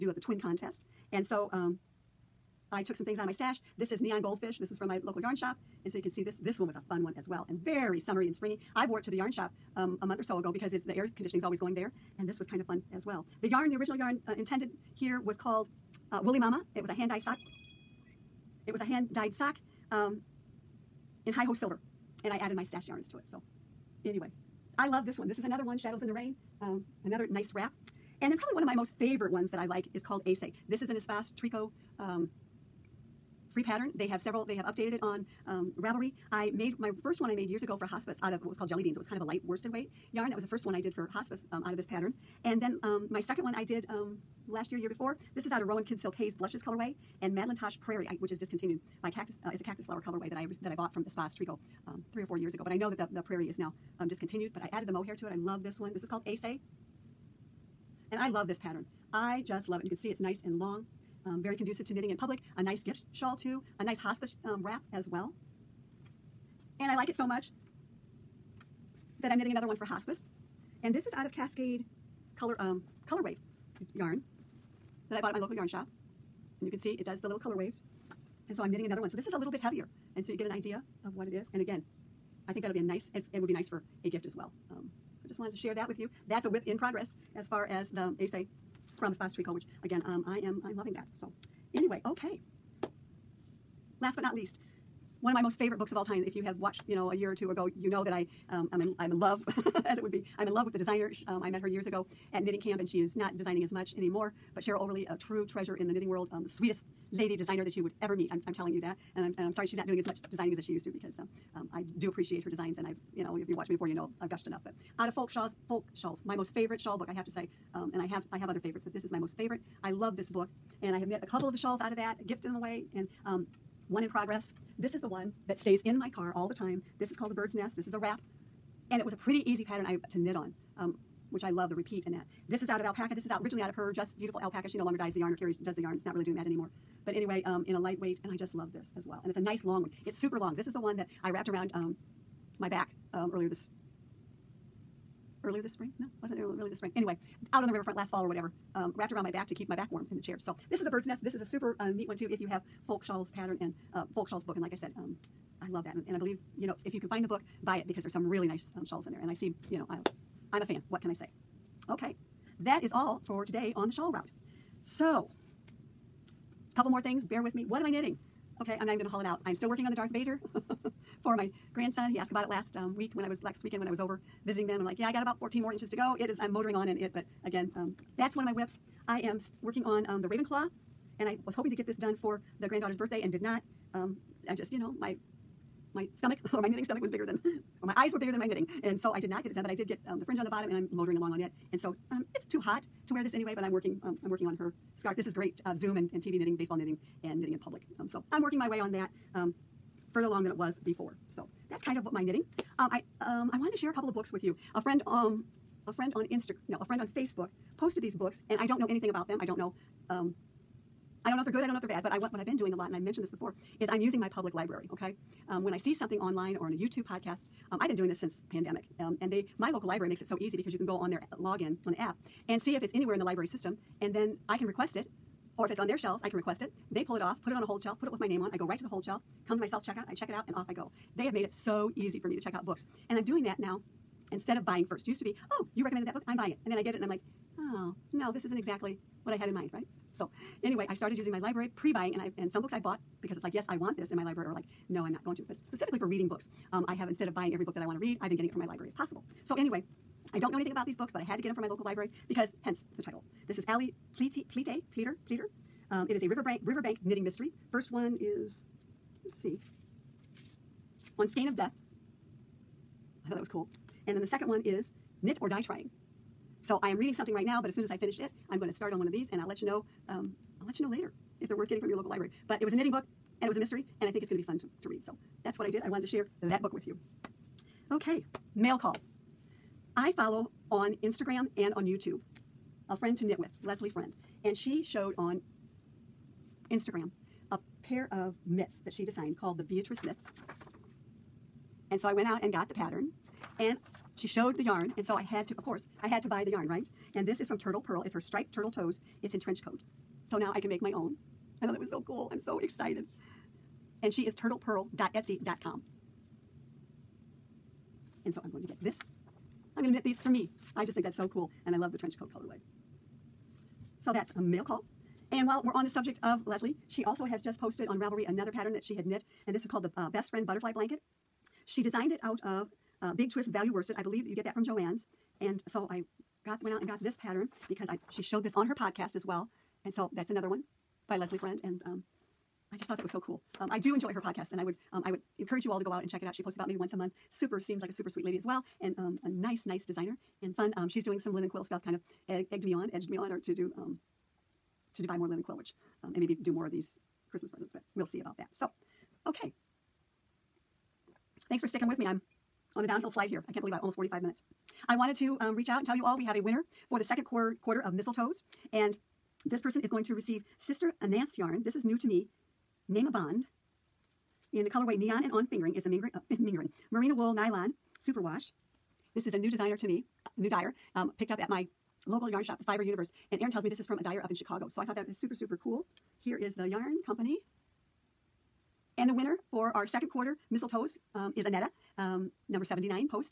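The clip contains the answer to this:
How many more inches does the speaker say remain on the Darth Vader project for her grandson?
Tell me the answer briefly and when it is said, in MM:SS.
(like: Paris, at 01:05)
14, at 02:55.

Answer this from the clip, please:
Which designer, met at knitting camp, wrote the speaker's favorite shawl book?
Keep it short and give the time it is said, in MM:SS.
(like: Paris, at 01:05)
Cheryl Oberle, at 01:44.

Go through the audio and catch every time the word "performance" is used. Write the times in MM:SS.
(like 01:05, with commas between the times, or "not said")
not said.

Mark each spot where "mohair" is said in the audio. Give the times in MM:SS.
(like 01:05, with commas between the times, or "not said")
00:54.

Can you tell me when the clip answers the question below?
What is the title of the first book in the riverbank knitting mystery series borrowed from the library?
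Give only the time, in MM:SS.
04:21.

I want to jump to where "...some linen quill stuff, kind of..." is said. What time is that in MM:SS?
05:41.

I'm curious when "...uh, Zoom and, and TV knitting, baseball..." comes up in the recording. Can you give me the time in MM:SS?
03:15.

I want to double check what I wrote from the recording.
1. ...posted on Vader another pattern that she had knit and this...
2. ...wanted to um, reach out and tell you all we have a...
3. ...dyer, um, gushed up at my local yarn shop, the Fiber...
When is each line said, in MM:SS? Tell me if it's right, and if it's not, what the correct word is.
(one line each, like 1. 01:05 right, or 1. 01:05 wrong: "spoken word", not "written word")
1. 05:17 wrong: "Ravelry", not "Vader"
2. 05:54 right
3. 06:10 wrong: "picked", not "gushed".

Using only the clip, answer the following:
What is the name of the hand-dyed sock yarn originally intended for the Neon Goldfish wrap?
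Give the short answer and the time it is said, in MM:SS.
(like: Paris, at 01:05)
Woolly Mama, at 00:16.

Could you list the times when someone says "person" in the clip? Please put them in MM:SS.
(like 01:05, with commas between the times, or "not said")
05:59.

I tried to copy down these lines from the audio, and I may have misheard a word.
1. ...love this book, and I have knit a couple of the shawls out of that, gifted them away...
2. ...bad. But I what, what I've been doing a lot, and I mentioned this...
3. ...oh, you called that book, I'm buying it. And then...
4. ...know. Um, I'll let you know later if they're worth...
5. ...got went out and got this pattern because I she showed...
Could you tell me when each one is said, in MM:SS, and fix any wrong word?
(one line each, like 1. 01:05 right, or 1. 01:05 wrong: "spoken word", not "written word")
1. 01:59 right
2. 03:31 right
3. 03:55 wrong: "recommended", not "called"
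4. 04:29 right
5. 05:26 right.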